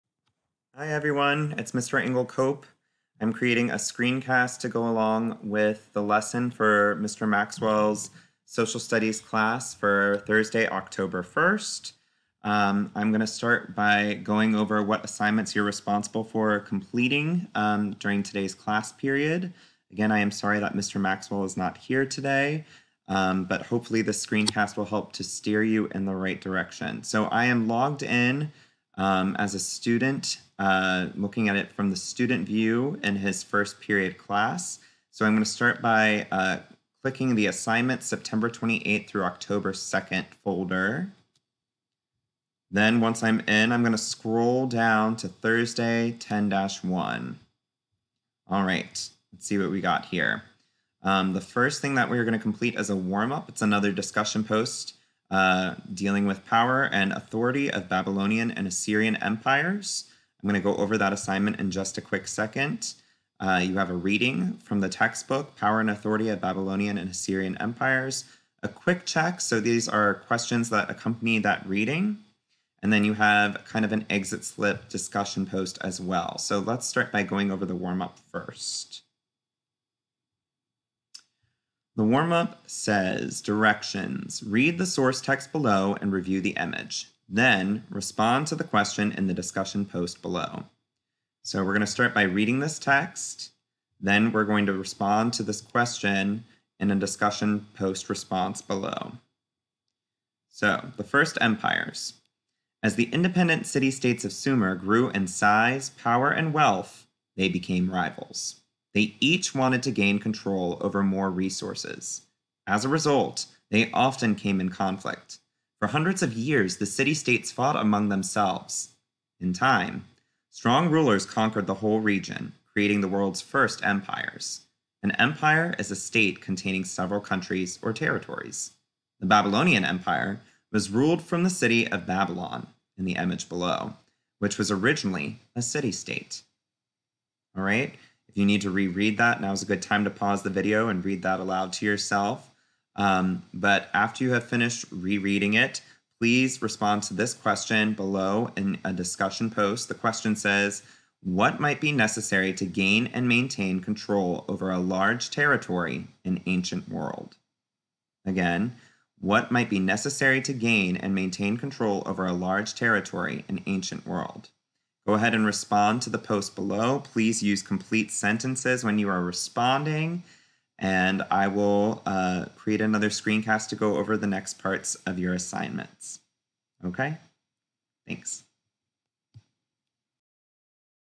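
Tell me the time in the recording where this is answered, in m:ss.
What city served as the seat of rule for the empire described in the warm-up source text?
2:12.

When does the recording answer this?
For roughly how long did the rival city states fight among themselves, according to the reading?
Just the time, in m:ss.
1:55.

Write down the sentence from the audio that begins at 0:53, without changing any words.
It's another discussion post uh, dealing with power and authority of Babylonian and Assyrian empires.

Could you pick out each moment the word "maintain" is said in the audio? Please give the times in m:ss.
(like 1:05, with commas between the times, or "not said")
2:33, 2:41.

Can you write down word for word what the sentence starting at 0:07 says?
Maxwell's social studies class for Thursday, October 1st.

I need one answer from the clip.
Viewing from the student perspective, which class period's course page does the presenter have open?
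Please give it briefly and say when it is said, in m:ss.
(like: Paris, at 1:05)
First period, at 0:33.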